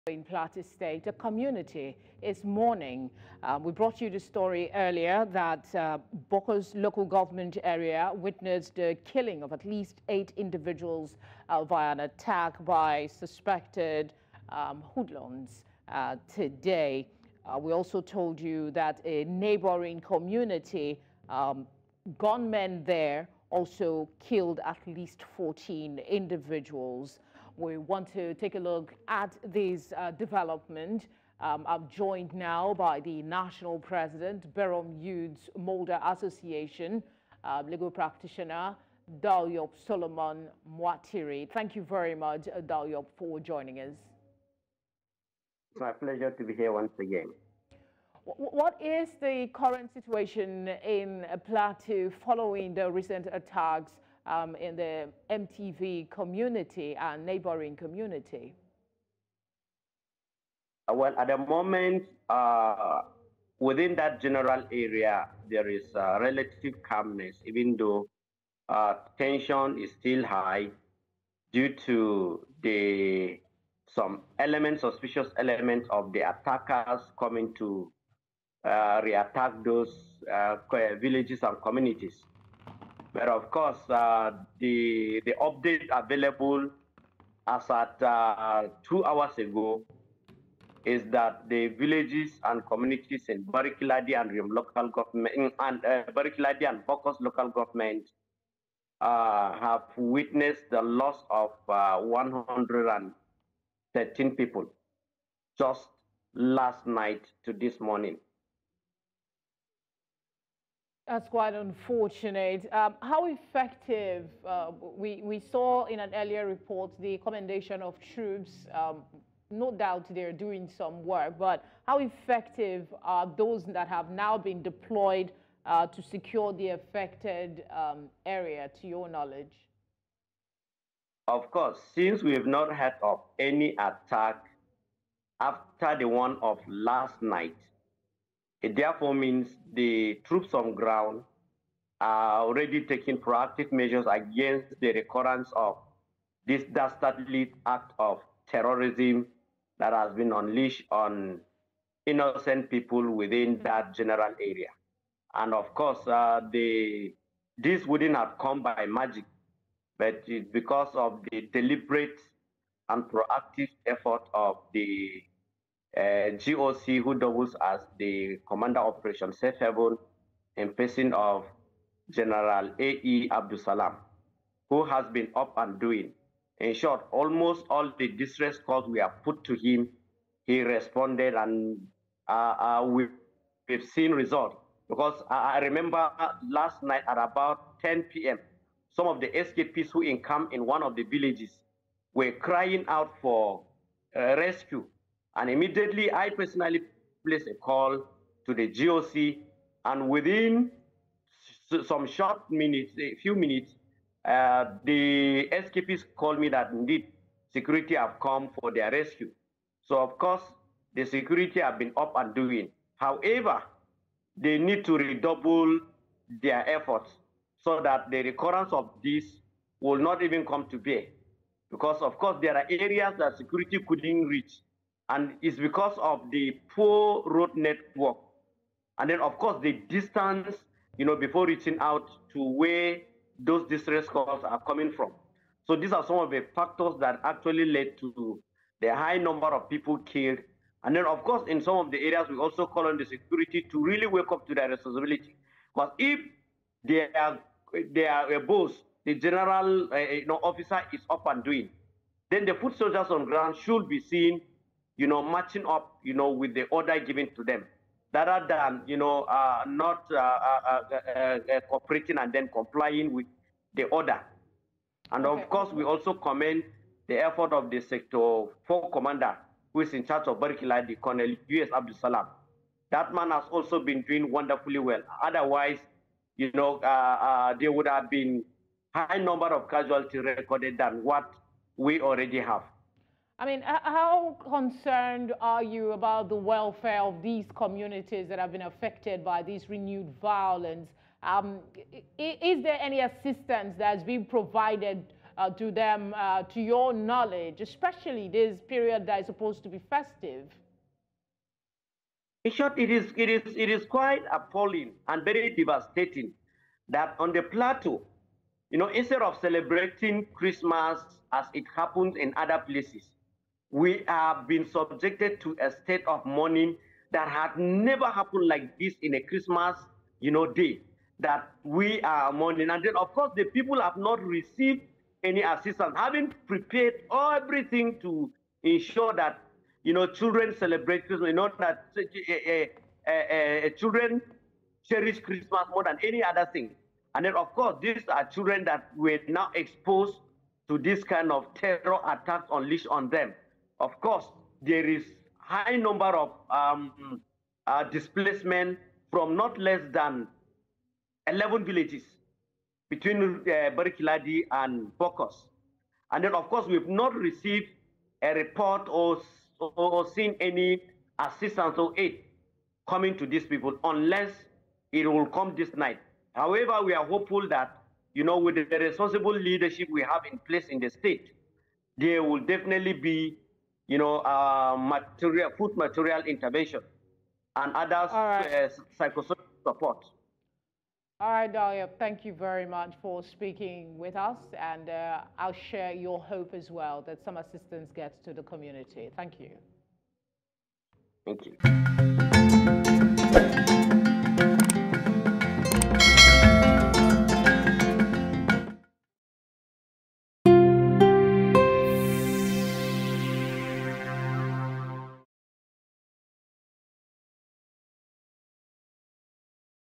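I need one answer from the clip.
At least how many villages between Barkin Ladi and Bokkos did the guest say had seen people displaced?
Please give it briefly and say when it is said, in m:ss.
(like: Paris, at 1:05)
11, at 5:51.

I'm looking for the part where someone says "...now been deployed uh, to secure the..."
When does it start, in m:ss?
2:04.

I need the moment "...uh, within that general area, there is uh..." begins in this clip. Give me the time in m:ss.
1:02.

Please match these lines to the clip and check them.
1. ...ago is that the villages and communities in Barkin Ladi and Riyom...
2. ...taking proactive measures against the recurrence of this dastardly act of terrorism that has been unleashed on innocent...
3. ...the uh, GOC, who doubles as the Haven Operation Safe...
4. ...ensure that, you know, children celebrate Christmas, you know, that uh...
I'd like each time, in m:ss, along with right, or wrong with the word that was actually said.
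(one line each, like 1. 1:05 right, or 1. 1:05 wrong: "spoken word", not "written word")
1. 1:29 right
2. 2:22 right
3. 2:44 wrong: "Commander", not "Haven"
4. 5:28 right.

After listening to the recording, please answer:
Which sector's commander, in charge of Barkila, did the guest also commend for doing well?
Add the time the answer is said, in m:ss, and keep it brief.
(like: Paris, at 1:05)
Sector 4, at 4:27.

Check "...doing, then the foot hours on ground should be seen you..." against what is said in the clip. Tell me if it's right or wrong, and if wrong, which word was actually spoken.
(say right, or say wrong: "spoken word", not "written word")
wrong: "soldiers", not "hours".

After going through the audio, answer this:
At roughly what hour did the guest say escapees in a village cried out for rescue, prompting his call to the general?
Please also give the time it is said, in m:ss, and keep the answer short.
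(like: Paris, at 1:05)
10 p.m., at 3:07.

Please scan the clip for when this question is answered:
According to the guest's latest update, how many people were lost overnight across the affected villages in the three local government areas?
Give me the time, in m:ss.
1:41.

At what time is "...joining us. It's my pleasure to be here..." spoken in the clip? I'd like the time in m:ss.
0:43.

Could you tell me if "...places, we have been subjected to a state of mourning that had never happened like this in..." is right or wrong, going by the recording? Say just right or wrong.
right.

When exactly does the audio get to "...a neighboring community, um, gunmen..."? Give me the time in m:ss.
0:19.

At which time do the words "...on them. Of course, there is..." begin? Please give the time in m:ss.
5:42.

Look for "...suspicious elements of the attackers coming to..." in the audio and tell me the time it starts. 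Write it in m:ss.
1:14.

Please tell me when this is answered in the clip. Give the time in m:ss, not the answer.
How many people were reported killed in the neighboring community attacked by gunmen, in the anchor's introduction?
0:25.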